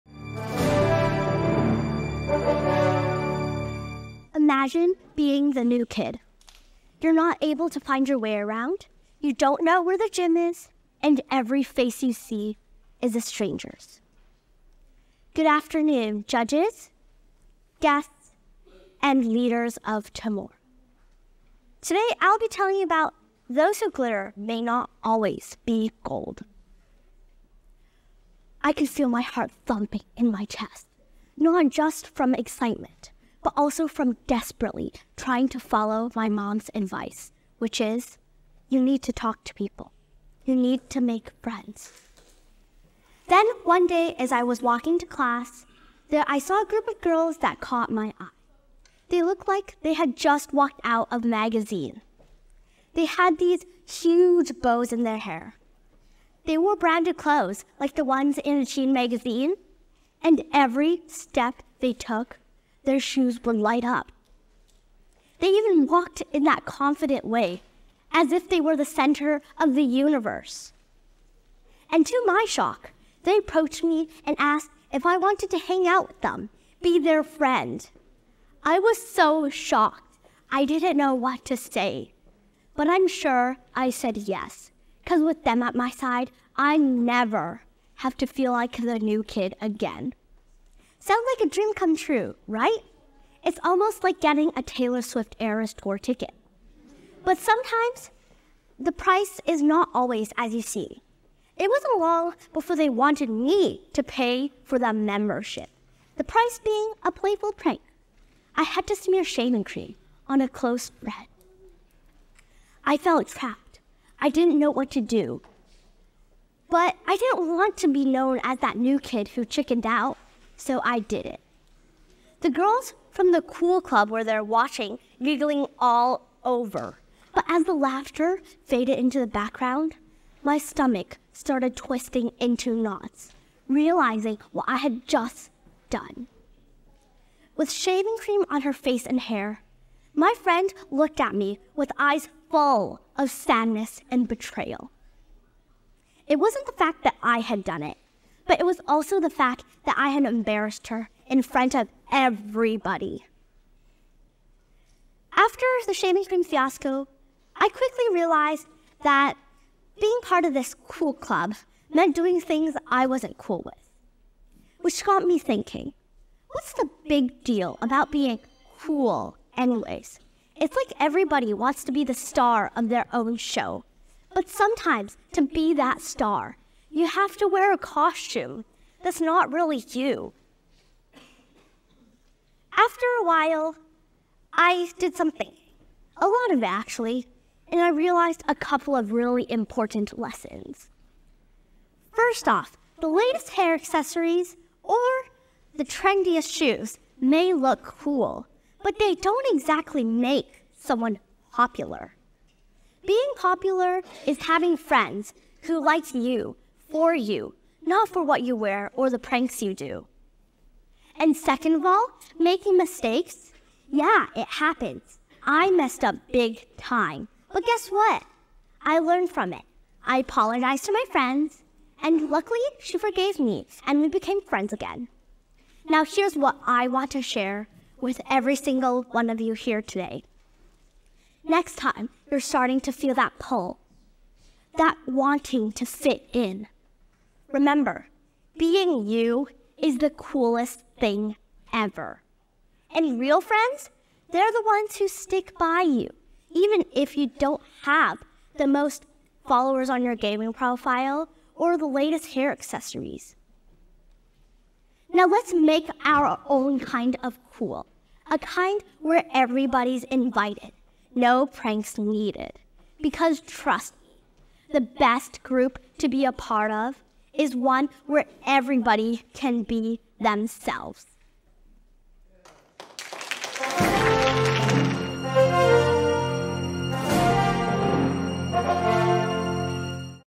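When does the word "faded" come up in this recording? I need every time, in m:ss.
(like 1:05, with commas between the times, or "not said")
2:08.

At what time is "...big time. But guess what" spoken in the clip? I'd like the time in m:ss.
3:36.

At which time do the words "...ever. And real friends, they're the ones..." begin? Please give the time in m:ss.
4:01.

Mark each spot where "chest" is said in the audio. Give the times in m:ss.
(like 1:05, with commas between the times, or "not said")
0:30.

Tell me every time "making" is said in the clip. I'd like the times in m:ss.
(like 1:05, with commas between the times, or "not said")
3:32.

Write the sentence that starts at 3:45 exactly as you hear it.
Now, here's what I want to share with every single one of you here today.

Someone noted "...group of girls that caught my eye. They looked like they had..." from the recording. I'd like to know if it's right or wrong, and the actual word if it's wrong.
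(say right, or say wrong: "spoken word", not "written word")
right.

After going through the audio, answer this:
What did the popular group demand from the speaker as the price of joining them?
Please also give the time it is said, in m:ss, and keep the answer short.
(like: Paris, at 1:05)
A playful prank, at 1:47.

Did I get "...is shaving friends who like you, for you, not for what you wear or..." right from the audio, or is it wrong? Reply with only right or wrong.
wrong.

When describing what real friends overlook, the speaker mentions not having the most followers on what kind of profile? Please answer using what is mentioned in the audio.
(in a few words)
Gaming profile.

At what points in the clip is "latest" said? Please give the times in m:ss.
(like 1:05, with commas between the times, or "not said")
3:13, 4:11.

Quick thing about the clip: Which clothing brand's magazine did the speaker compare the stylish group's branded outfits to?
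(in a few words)
Shein.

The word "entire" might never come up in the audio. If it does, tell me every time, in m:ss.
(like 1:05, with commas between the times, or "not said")
not said.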